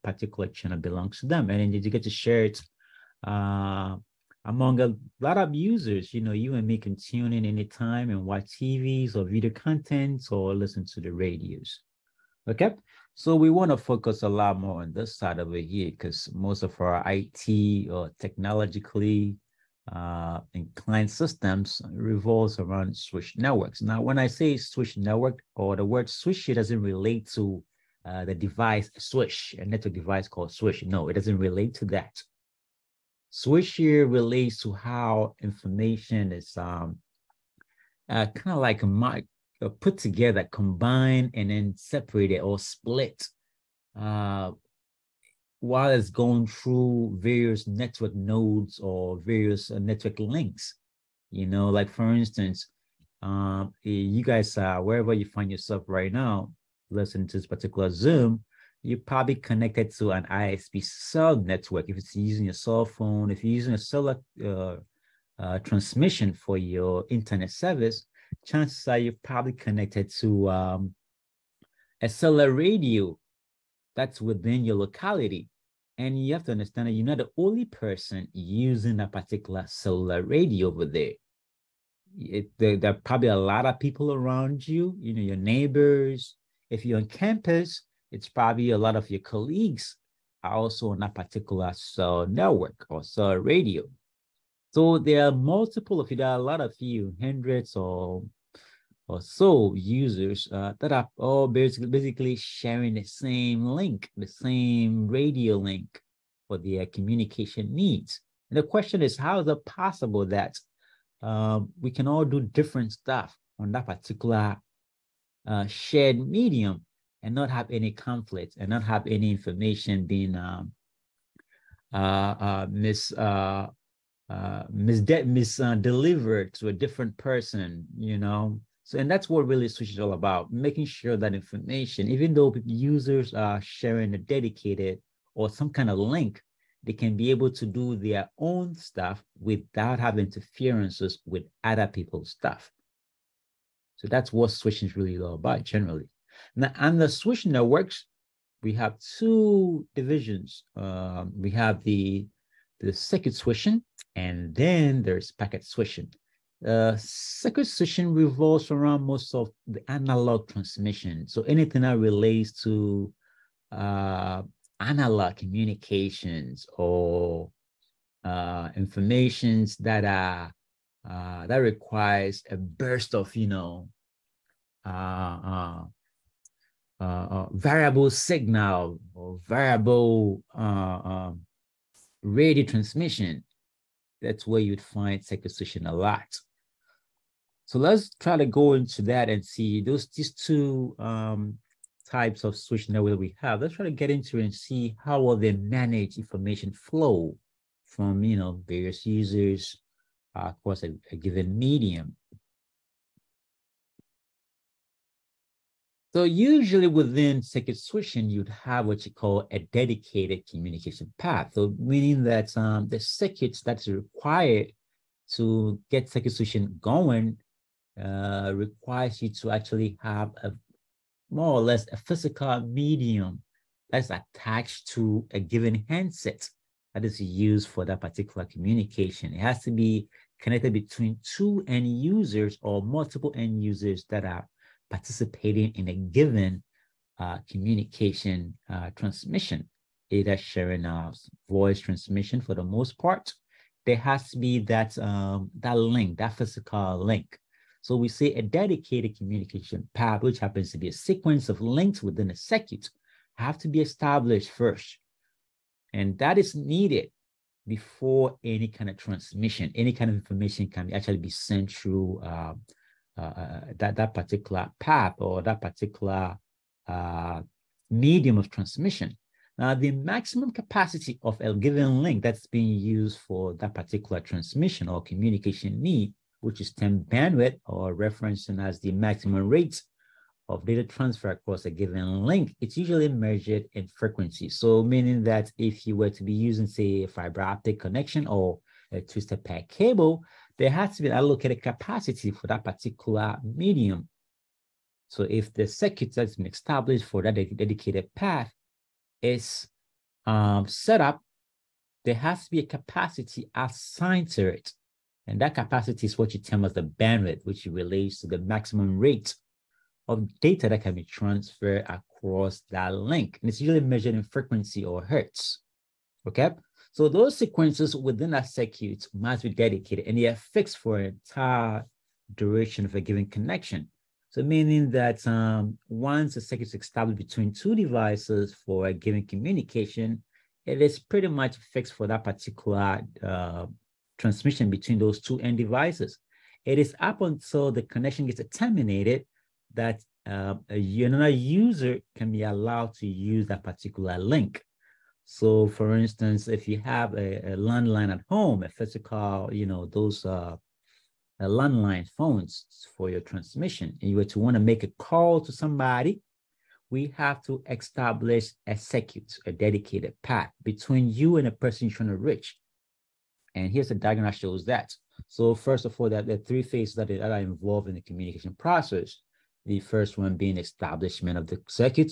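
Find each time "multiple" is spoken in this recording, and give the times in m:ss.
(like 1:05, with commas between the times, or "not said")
1:35, 3:52.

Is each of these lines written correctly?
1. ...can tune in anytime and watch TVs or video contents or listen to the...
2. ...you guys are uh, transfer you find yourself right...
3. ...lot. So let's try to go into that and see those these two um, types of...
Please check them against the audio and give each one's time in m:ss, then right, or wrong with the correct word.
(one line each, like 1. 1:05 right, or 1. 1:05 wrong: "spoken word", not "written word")
1. 0:06 right
2. 0:53 wrong: "wherever", not "transfer"
3. 3:05 right.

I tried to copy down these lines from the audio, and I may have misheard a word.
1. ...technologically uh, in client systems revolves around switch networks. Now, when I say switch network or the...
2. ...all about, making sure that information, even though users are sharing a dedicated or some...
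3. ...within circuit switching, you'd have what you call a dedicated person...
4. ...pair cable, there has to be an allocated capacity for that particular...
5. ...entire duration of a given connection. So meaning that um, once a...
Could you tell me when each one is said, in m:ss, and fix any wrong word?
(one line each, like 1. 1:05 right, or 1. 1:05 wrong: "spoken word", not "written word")
1. 0:18 right
2. 2:09 right
3. 3:26 wrong: "communication", not "person"
4. 4:49 right
5. 5:21 right.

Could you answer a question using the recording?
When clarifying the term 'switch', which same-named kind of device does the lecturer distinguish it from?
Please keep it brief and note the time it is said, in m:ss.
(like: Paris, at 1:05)
network device, at 0:29.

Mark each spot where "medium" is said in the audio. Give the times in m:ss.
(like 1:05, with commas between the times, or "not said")
1:56, 3:21, 3:42, 4:27, 4:53.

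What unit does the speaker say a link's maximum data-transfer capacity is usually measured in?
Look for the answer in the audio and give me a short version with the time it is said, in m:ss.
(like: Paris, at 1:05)
hertz, at 5:15.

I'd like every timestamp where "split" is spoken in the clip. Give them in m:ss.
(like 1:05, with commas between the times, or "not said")
0:42.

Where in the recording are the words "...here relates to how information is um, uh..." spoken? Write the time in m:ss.
0:33.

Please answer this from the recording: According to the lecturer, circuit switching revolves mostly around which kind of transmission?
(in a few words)
analog transmission.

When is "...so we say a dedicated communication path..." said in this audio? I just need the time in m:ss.
4:07.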